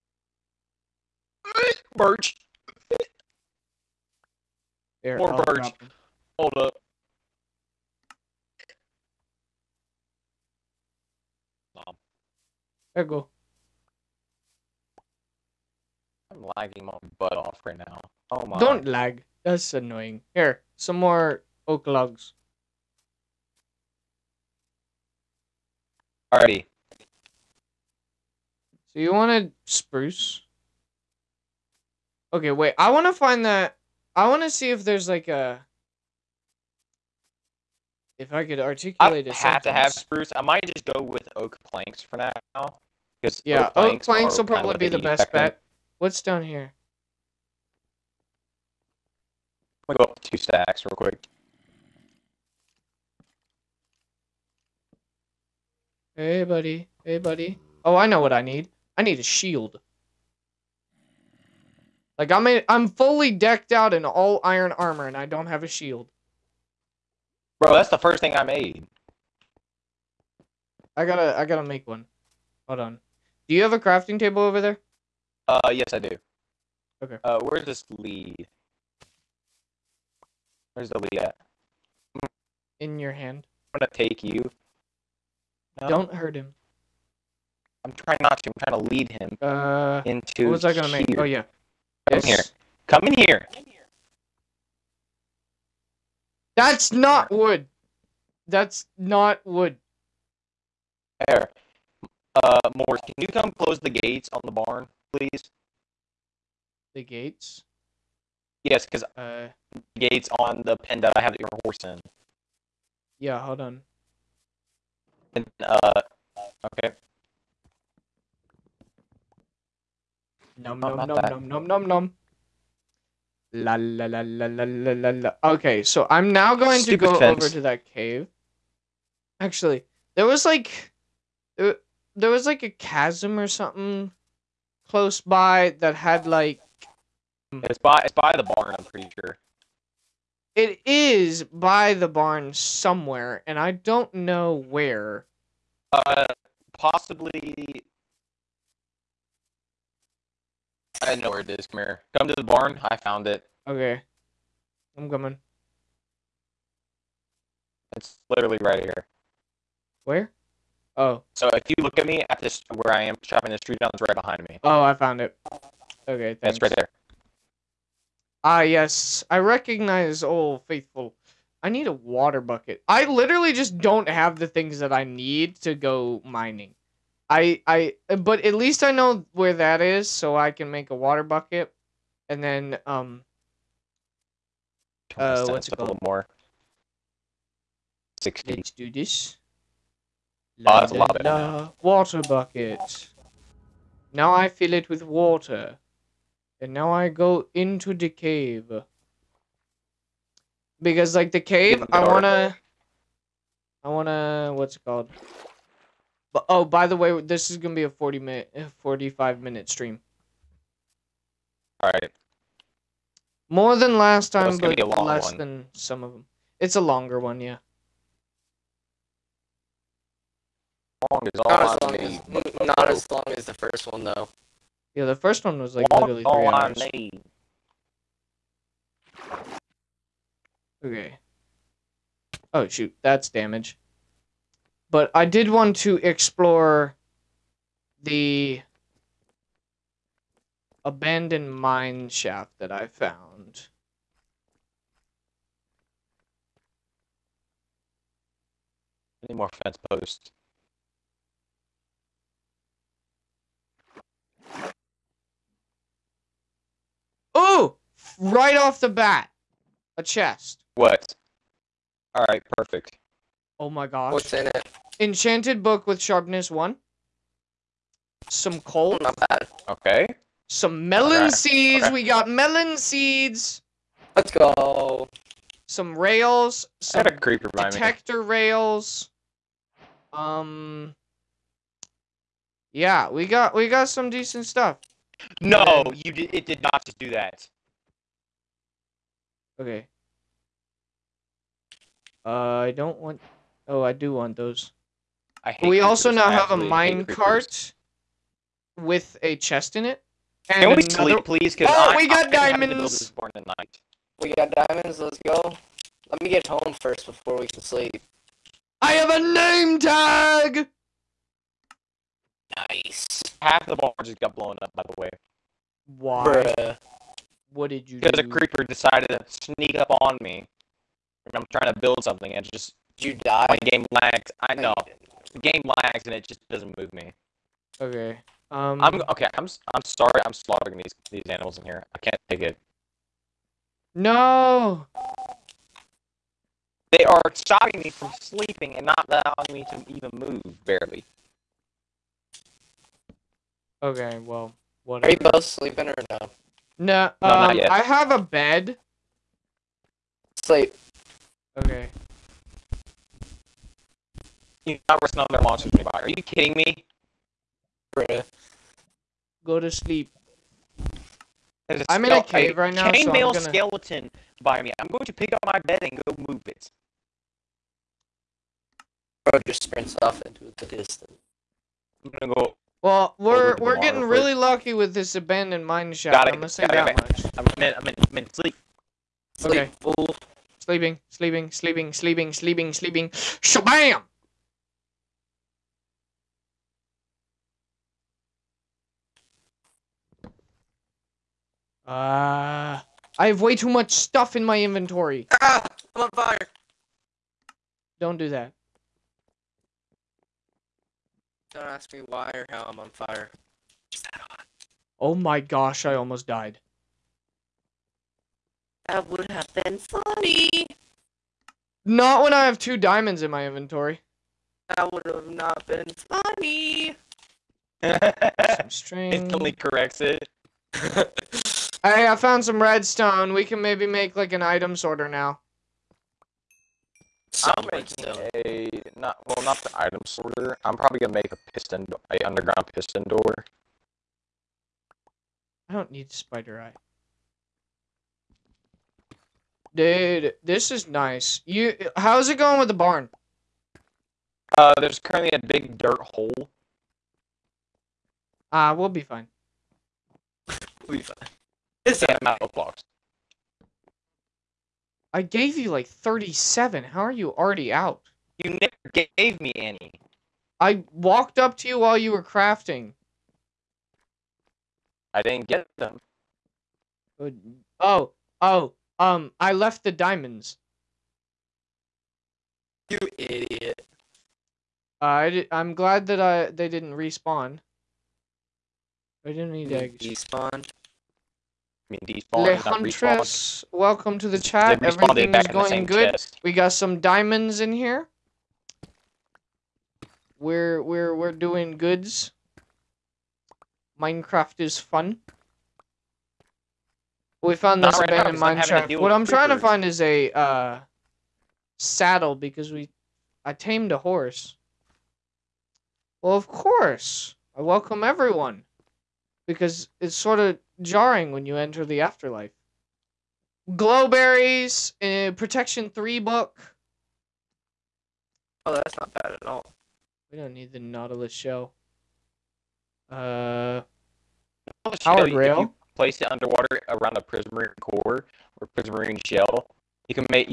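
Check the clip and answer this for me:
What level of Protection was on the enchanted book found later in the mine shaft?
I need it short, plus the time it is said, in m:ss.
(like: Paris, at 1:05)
3, at 8:35.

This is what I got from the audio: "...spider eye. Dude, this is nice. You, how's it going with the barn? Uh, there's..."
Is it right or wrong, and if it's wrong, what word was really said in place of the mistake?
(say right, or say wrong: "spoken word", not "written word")
right.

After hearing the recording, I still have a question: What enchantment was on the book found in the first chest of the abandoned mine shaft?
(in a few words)
Sharpness 1.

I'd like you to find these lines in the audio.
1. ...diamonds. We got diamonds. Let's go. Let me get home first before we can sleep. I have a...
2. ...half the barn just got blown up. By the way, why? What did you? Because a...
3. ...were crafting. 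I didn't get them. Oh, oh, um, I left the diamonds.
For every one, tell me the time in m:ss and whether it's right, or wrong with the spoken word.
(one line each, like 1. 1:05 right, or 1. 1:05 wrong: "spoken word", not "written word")
1. 5:02 right
2. 5:13 right
3. 7:42 right.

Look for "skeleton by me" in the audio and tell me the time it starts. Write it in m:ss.
6:03.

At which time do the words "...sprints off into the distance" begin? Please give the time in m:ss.
6:09.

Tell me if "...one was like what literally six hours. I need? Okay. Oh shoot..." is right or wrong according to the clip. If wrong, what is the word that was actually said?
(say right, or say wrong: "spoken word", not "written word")
wrong: "three", not "six".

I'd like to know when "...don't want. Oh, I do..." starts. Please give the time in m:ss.
4:52.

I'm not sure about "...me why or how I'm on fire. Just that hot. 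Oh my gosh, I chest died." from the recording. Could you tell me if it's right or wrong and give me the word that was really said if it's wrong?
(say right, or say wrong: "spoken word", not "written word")
wrong: "almost", not "chest".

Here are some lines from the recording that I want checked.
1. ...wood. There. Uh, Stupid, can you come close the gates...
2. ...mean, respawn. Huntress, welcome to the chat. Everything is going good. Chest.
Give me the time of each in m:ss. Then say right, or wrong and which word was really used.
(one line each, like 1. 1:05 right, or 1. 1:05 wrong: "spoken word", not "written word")
1. 1:39 wrong: "Morris", not "Stupid"
2. 8:01 wrong: "despawn", not "respawn".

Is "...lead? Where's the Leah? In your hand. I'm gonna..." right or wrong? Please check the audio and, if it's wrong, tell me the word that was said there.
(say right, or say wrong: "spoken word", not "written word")
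right.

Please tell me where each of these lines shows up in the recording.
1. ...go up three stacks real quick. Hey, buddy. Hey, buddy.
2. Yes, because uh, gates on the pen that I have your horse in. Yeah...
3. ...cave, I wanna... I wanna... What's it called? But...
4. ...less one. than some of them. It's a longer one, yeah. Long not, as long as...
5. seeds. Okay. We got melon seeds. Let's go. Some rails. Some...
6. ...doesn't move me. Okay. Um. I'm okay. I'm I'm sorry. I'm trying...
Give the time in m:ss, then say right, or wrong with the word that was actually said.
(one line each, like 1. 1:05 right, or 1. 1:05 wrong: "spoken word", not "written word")
1. 0:49 wrong: "two", not "three"
2. 1:48 right
3. 3:21 right
4. 3:35 right
5. 4:31 right
6. 5:26 wrong: "slaughtering", not "trying".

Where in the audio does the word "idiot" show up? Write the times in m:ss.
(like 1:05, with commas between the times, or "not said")
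7:53.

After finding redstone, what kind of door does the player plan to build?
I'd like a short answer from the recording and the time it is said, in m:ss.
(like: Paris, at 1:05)
Underground piston door, at 7:12.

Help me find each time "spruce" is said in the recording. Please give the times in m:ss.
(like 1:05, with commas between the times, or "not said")
0:29, 0:39.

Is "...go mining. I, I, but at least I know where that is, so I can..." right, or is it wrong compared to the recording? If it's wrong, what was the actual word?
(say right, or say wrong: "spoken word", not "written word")
right.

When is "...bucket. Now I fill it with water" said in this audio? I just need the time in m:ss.
3:12.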